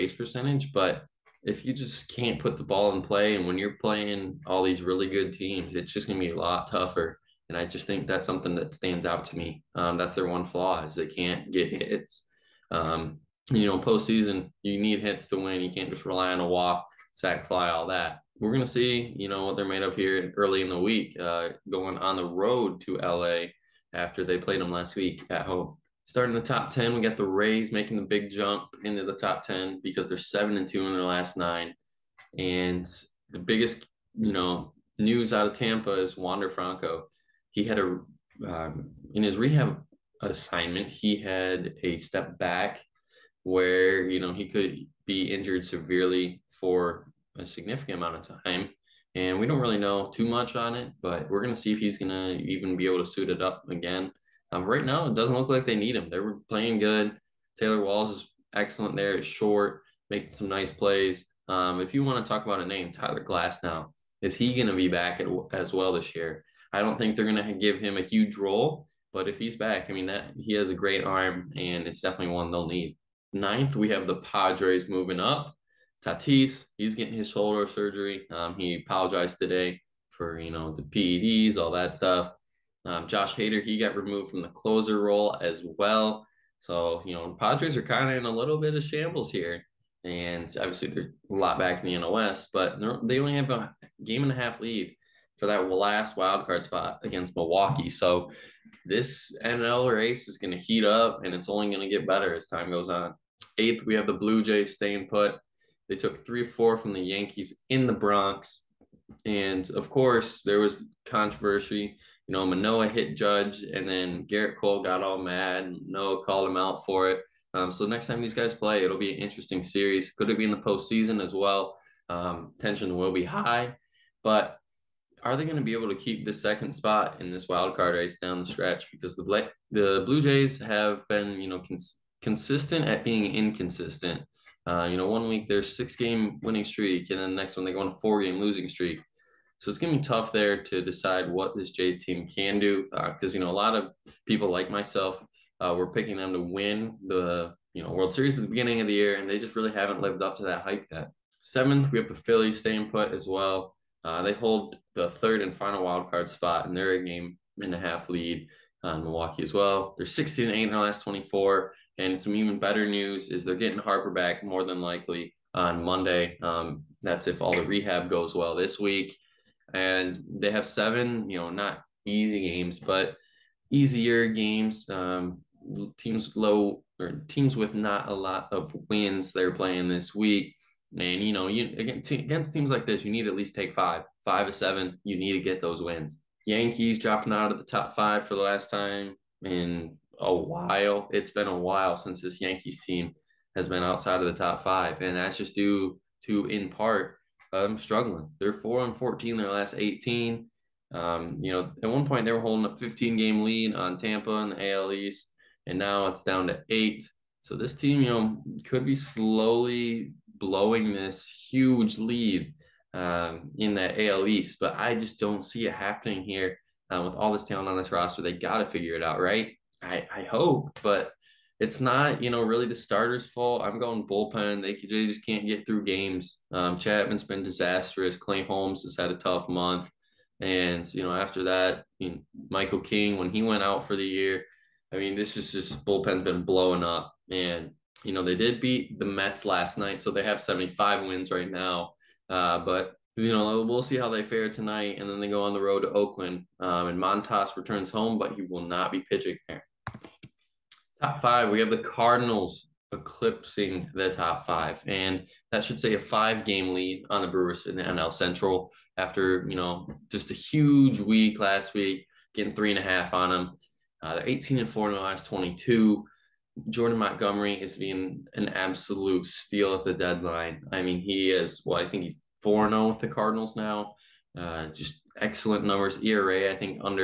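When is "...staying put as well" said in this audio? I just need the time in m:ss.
2:32.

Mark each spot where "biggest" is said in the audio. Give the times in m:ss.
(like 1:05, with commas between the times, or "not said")
0:33.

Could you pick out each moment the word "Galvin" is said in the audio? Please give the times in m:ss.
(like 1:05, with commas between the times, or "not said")
not said.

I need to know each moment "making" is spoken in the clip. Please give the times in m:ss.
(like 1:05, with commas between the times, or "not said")
0:27, 1:00.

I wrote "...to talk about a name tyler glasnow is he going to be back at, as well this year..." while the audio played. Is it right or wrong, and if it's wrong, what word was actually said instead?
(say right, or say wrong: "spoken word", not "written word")
right.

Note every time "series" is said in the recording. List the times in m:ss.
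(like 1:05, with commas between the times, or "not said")
1:59, 2:28.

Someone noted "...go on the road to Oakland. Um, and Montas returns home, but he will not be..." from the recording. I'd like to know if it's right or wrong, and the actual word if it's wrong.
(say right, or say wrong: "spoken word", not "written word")
right.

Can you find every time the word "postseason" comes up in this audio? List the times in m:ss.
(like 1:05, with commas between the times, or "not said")
0:13, 2:00.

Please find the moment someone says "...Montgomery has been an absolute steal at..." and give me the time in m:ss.
4:26.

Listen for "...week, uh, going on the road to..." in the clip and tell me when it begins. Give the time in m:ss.
0:20.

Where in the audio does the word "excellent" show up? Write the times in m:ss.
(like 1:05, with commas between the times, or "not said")
0:58, 4:35.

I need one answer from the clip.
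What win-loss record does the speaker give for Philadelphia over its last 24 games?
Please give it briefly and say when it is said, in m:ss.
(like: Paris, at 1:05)
16-8, at 2:40.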